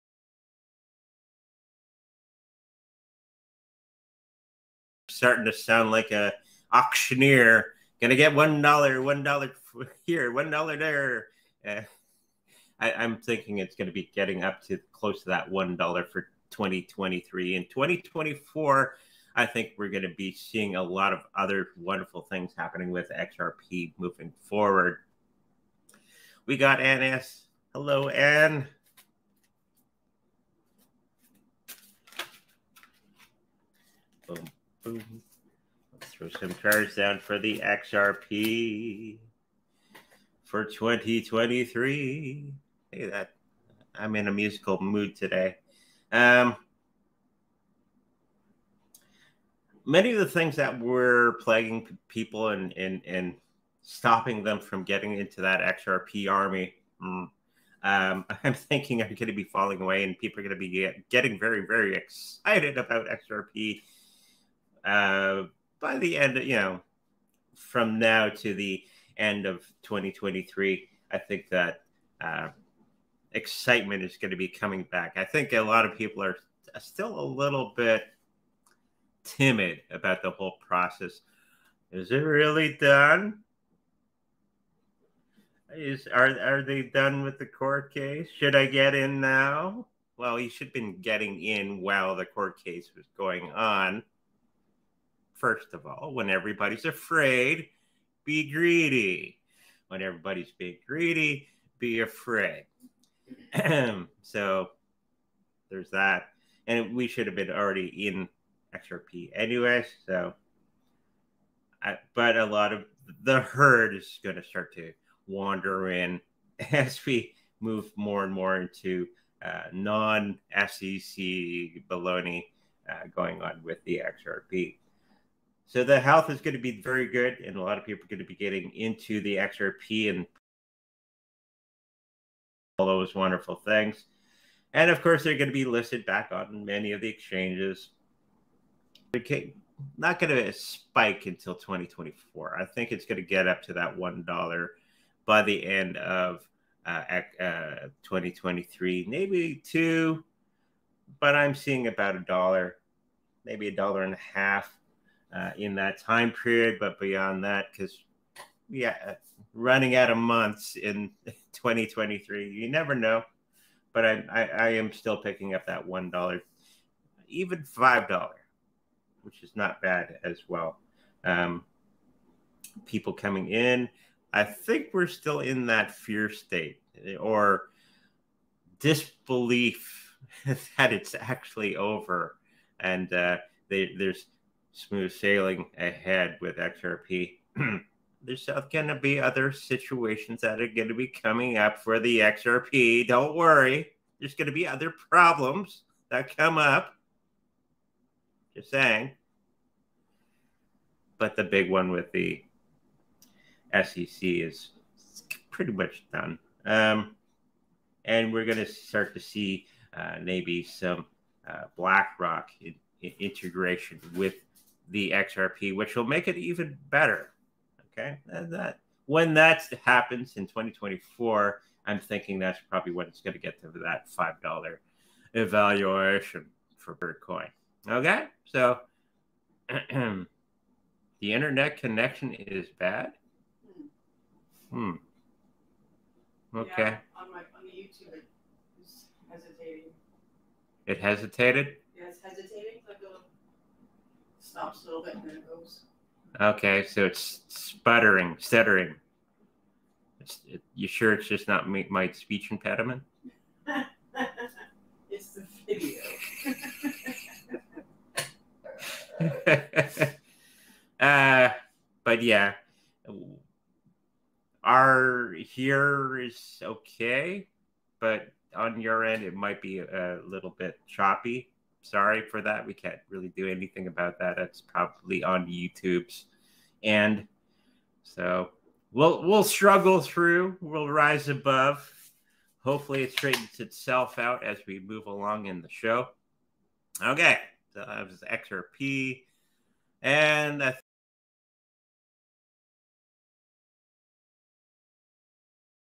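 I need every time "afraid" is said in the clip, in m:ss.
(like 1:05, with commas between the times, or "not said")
1:36, 1:42.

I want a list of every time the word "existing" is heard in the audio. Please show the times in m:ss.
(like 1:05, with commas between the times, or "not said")
not said.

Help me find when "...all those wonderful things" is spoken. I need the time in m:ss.
2:12.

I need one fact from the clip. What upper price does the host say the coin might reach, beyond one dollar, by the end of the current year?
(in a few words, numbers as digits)
a dollar and a half.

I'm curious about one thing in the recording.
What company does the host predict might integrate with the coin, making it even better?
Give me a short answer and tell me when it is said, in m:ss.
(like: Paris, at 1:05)
BlackRock, at 3:31.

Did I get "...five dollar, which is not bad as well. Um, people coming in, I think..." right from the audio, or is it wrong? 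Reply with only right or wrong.
right.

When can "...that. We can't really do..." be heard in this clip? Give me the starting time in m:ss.
4:32.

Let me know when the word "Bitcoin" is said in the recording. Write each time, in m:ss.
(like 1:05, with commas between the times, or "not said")
3:46.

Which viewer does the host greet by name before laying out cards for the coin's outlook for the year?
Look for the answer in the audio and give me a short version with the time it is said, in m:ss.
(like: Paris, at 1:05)
Anne S, at 0:26.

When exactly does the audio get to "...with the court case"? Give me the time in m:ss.
1:27.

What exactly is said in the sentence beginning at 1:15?
I think a lot of people are still a little bit timid about the whole process.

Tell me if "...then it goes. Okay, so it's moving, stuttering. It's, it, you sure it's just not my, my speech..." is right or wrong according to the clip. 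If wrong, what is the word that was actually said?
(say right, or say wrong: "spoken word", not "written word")
wrong: "sputtering", not "moving".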